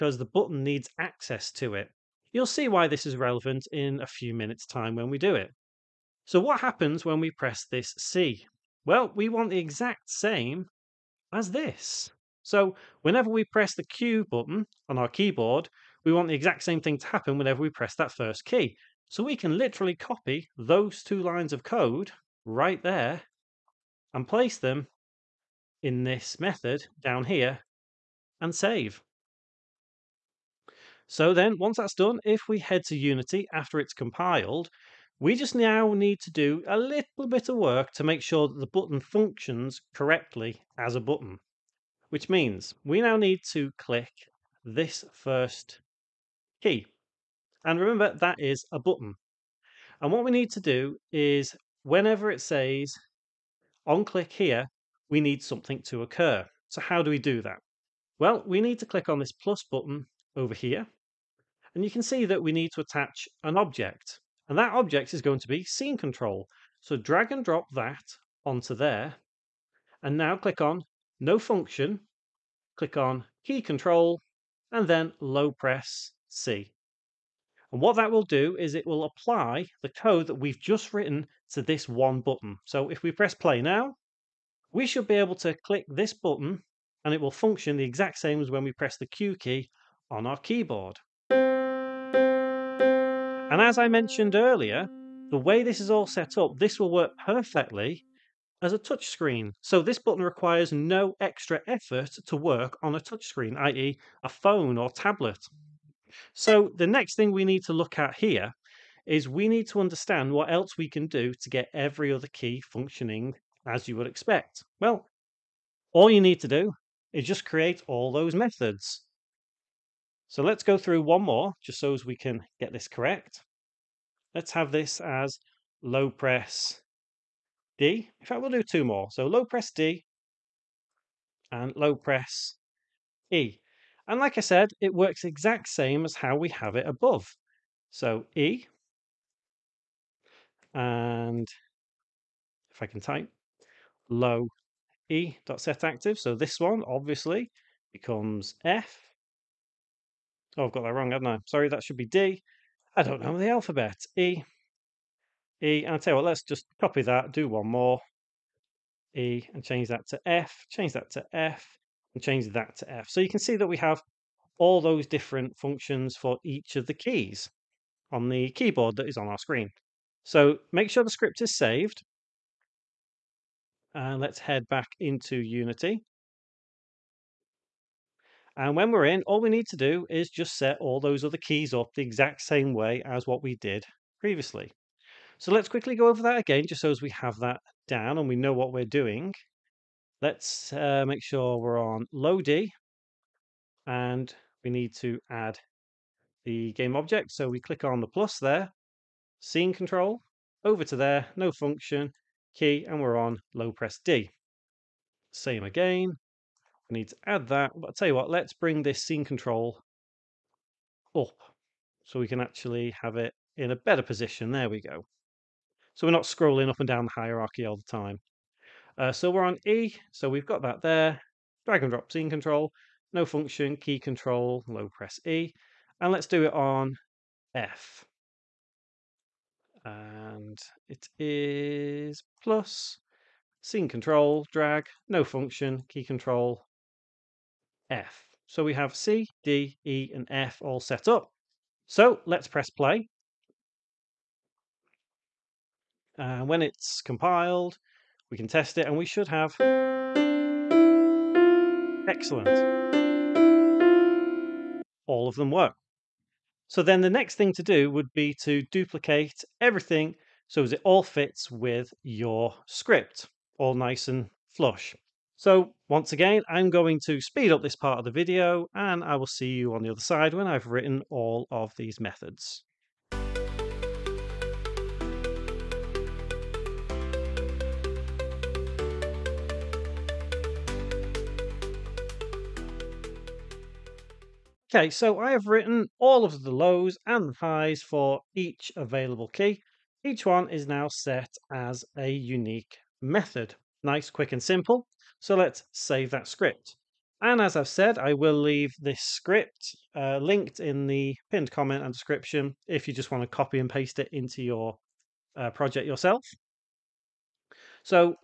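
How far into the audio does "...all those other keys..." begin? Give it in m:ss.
3:00.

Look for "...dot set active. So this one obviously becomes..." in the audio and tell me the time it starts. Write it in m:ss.
2:25.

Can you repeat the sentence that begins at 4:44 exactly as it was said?
Okay, so I have written all of the lows and the highs for each available key.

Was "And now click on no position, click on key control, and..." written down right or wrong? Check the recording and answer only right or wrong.
wrong.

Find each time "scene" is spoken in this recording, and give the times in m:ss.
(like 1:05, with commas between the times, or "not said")
1:05, 3:19, 3:29, 3:42, 3:53.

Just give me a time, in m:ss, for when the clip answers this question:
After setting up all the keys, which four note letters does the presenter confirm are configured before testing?
3:58.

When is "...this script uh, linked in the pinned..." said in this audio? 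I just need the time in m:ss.
4:58.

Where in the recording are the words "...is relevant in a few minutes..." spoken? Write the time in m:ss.
0:03.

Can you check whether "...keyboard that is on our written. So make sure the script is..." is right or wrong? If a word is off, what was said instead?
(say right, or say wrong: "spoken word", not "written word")
wrong: "screen", not "written".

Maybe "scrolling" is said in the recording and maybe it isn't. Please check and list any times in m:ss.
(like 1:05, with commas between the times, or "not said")
3:36.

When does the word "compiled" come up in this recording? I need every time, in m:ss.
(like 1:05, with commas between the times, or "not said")
0:33, 4:07.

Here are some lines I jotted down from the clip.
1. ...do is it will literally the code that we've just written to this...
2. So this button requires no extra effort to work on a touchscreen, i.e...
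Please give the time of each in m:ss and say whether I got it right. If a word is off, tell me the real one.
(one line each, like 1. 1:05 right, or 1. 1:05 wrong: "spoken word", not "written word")
1. 1:18 wrong: "apply", not "literally"
2. 1:39 right.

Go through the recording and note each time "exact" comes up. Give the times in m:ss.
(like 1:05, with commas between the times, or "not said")
0:09, 0:16, 1:27, 2:15, 3:02.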